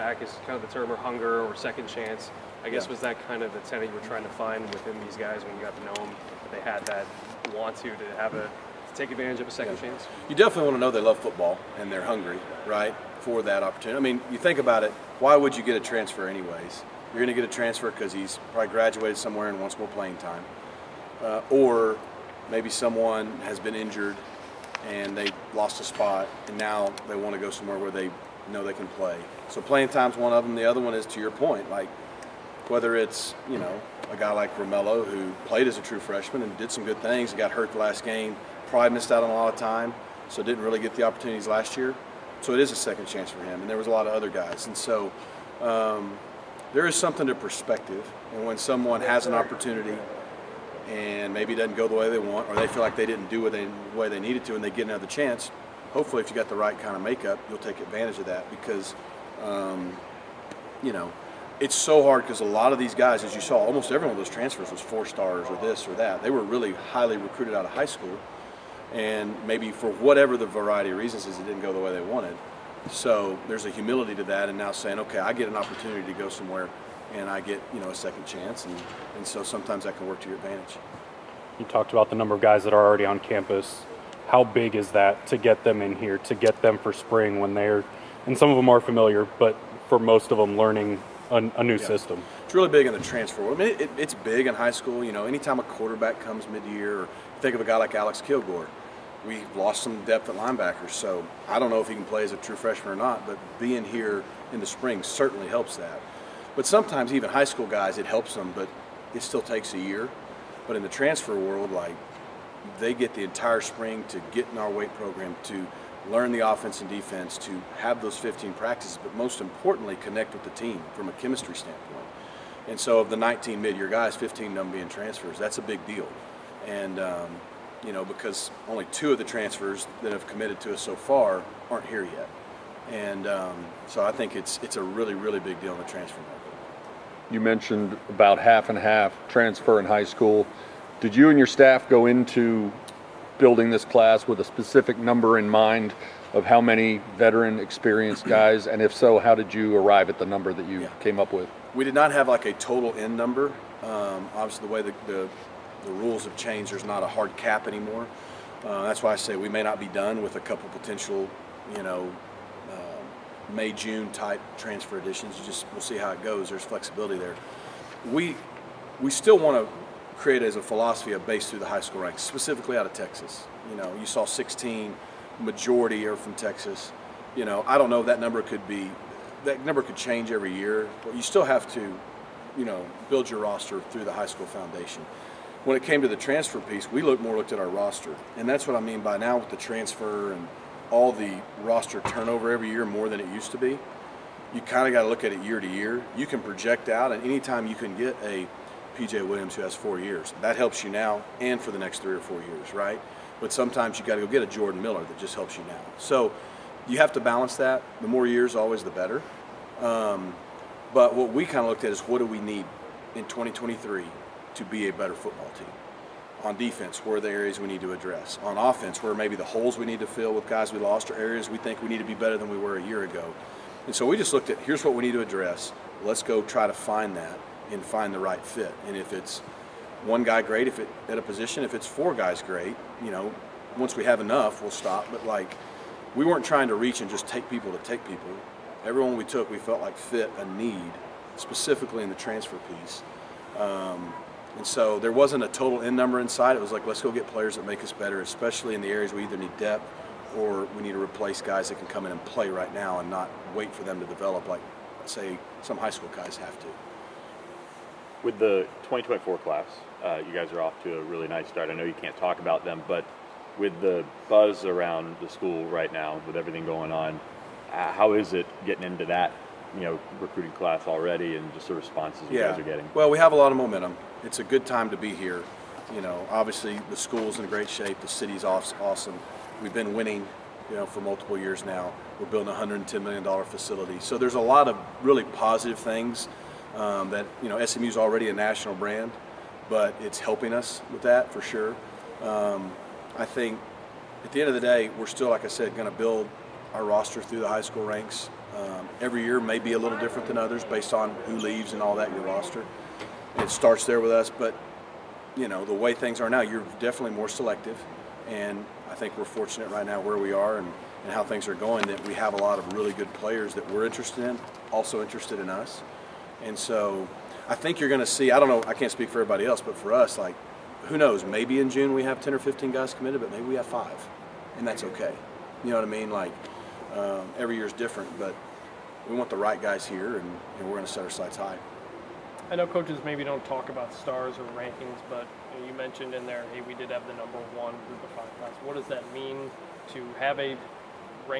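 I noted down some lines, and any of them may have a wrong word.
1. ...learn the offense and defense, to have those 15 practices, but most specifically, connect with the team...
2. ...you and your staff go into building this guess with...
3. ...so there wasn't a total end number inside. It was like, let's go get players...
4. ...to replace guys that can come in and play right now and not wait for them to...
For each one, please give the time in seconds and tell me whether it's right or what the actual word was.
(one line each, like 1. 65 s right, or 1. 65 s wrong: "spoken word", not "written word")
1. 116 s wrong: "importantly", not "specifically"
2. 141 s wrong: "class", not "guess"
3. 244 s right
4. 250 s right.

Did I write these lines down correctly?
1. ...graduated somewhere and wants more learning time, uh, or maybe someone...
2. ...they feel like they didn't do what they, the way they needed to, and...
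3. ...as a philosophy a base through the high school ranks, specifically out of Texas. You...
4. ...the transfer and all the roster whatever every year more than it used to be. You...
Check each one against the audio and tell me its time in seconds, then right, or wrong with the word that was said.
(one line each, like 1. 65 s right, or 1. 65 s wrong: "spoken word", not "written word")
1. 18 s wrong: "playing", not "learning"
2. 52 s right
3. 170 s right
4. 189 s wrong: "turnover", not "whatever".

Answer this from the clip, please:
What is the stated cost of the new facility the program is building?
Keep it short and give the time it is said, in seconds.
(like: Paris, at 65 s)
$110 million, at 282 s.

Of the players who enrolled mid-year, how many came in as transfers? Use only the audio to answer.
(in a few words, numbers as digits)
15.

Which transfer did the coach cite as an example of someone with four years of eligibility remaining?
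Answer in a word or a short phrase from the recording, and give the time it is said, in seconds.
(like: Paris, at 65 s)
PJ Williams, at 198 s.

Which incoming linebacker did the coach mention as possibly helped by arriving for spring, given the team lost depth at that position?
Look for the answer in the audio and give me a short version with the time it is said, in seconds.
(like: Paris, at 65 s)
Alex Kilgore, at 97 s.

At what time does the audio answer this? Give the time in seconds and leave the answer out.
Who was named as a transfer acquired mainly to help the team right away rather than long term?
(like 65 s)
204 s.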